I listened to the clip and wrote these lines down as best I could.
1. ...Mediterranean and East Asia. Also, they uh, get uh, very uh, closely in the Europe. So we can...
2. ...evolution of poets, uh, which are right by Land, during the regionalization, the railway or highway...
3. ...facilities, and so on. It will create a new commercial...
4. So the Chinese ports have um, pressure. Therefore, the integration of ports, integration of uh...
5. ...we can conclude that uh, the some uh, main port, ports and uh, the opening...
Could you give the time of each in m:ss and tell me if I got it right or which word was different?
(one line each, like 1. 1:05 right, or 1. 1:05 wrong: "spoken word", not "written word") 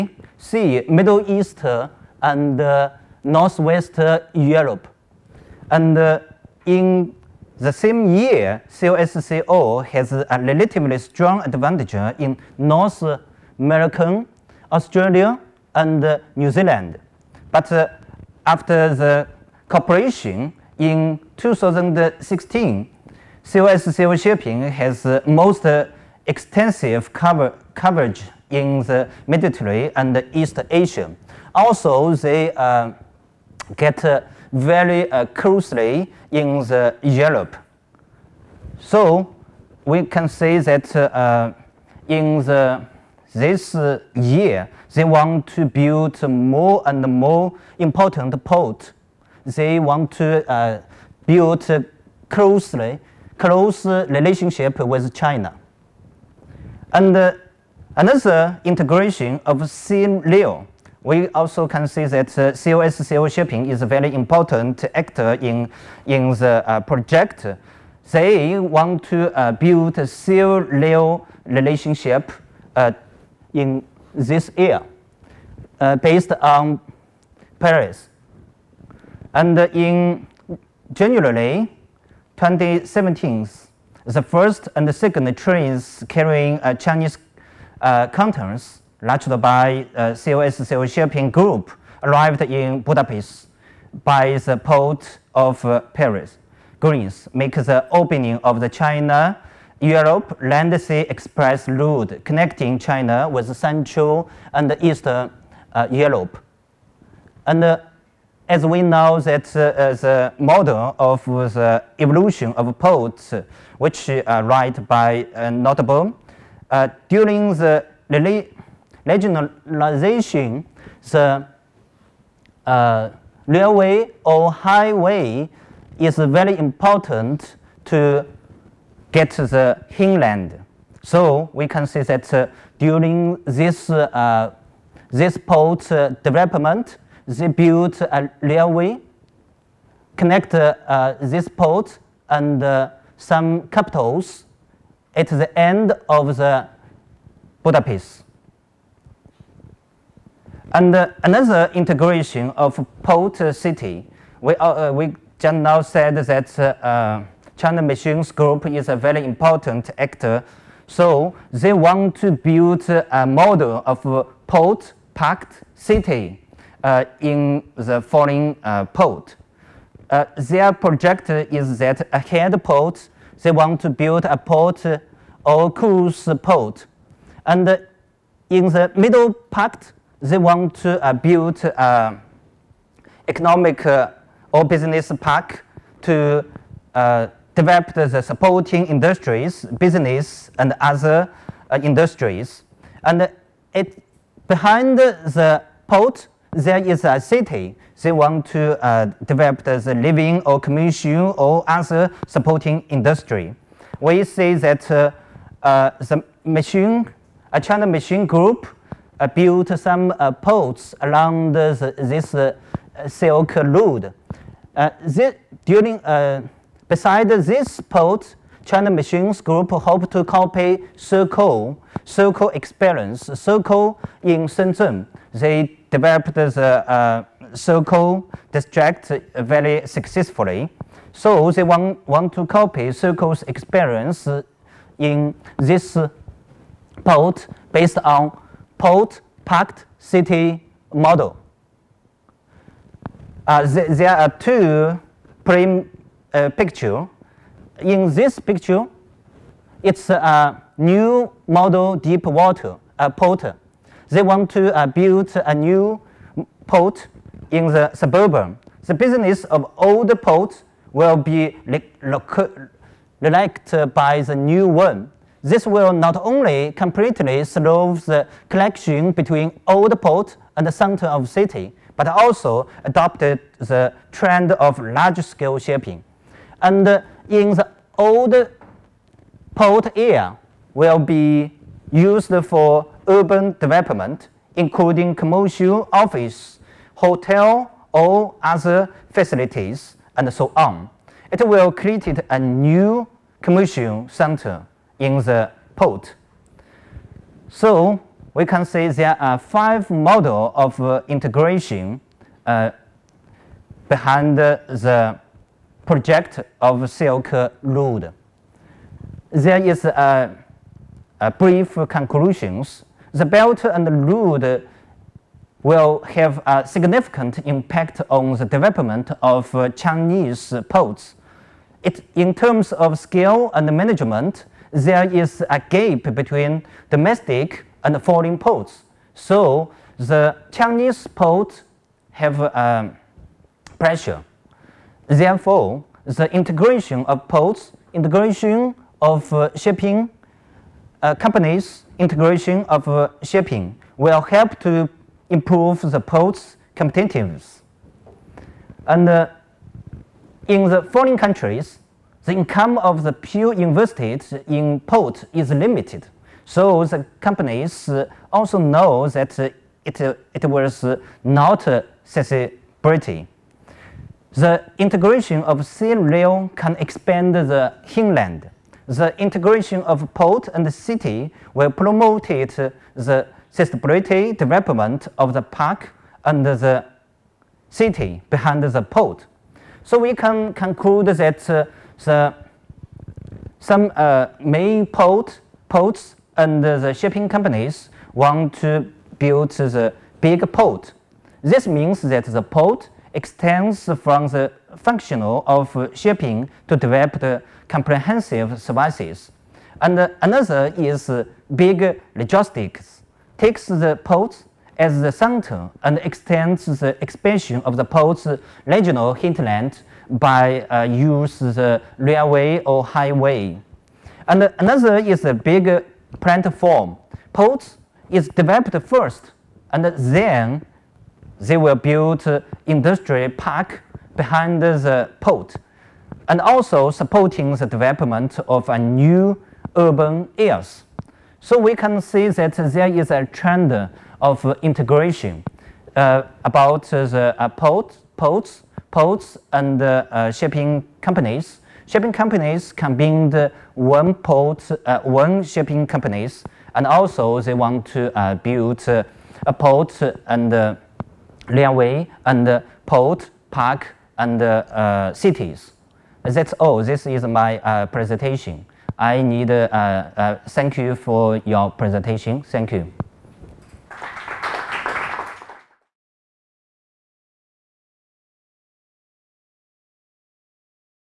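1. 0:29 right
2. 1:51 wrong: "Notteboom", not "Land"
3. 4:49 right
4. 5:29 right
5. 6:19 wrong: "shipping", not "opening".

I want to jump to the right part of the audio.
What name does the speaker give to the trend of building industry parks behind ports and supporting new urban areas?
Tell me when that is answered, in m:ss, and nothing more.
6:55.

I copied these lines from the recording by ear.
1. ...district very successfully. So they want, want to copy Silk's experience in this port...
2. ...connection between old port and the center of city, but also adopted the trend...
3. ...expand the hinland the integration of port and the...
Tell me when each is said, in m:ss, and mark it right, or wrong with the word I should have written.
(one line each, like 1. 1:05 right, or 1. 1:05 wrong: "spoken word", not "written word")
1. 3:48 wrong: "Shekou", not "Silk"
2. 4:28 right
3. 6:06 right.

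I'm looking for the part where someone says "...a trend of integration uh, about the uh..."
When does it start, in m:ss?
7:13.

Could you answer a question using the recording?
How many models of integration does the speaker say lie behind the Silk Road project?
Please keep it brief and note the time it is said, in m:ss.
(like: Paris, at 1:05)
5, at 4:59.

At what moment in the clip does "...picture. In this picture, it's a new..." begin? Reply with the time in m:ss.
4:06.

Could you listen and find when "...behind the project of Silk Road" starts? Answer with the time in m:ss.
5:03.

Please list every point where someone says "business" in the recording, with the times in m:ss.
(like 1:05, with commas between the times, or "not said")
3:04, 3:09, 4:18.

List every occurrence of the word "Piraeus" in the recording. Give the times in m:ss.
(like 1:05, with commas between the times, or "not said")
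1:17, 1:35.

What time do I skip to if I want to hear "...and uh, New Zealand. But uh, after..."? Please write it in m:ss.
0:15.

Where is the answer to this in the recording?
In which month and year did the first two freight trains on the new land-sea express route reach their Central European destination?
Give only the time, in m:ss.
1:20.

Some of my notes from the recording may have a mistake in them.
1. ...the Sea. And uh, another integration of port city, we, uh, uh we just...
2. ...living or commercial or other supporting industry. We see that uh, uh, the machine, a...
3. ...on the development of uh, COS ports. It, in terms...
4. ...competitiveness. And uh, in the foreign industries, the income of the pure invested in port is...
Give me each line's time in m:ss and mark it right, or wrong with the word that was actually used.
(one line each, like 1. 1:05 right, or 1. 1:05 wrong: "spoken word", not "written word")
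1. 2:26 wrong: "Budapest", not "Sea"
2. 3:19 right
3. 5:18 wrong: "Chinese", not "COS"
4. 5:46 wrong: "countries", not "industries".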